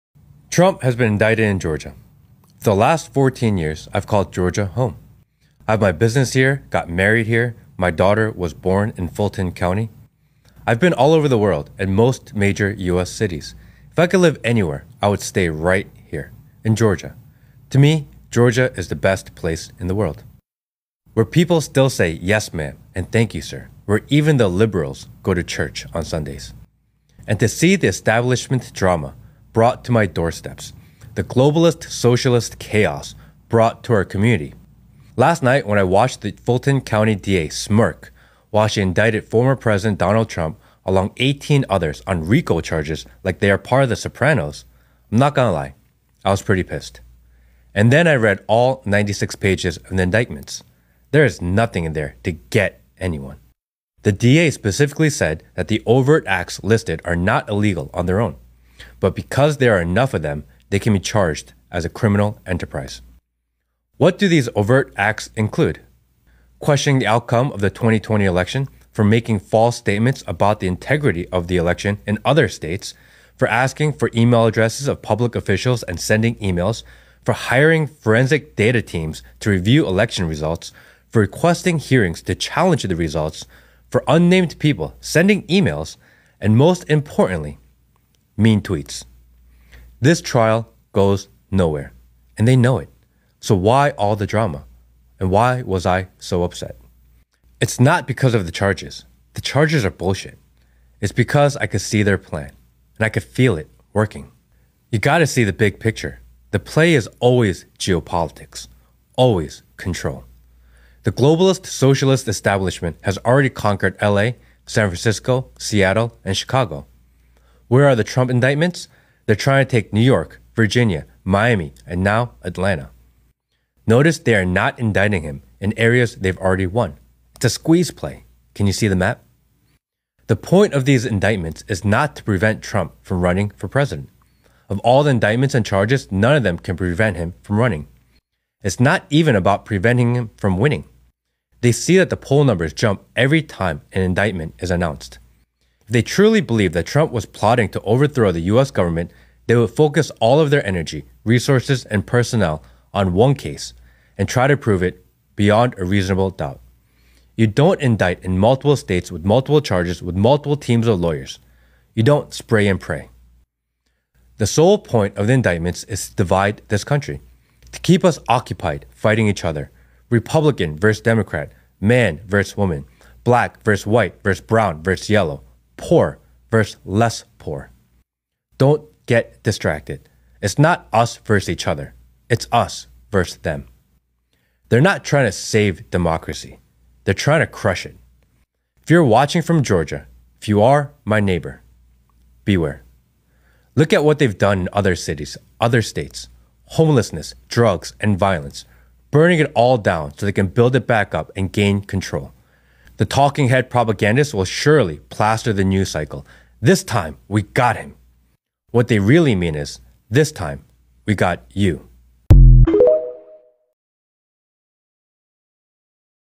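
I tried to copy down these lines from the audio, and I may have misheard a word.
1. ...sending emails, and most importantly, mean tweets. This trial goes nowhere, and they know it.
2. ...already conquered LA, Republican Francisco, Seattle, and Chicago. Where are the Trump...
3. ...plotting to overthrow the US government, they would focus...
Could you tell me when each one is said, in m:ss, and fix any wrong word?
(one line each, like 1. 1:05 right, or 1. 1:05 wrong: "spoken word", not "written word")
1. 1:24 right
2. 1:53 wrong: "San", not "Republican"
3. 2:27 right.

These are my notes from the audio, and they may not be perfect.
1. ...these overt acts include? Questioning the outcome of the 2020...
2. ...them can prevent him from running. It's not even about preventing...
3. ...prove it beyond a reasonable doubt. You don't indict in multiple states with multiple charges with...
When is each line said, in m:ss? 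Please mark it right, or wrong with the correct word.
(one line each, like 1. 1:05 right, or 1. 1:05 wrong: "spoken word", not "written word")
1. 1:04 right
2. 2:16 right
3. 2:34 right.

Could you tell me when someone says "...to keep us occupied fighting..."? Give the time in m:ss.
2:47.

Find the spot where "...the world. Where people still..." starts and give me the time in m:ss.
0:19.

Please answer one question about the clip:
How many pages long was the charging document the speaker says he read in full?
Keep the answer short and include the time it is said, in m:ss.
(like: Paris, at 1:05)
96, at 0:48.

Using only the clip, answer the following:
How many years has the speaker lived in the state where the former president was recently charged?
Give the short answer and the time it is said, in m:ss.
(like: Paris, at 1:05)
14, at 0:03.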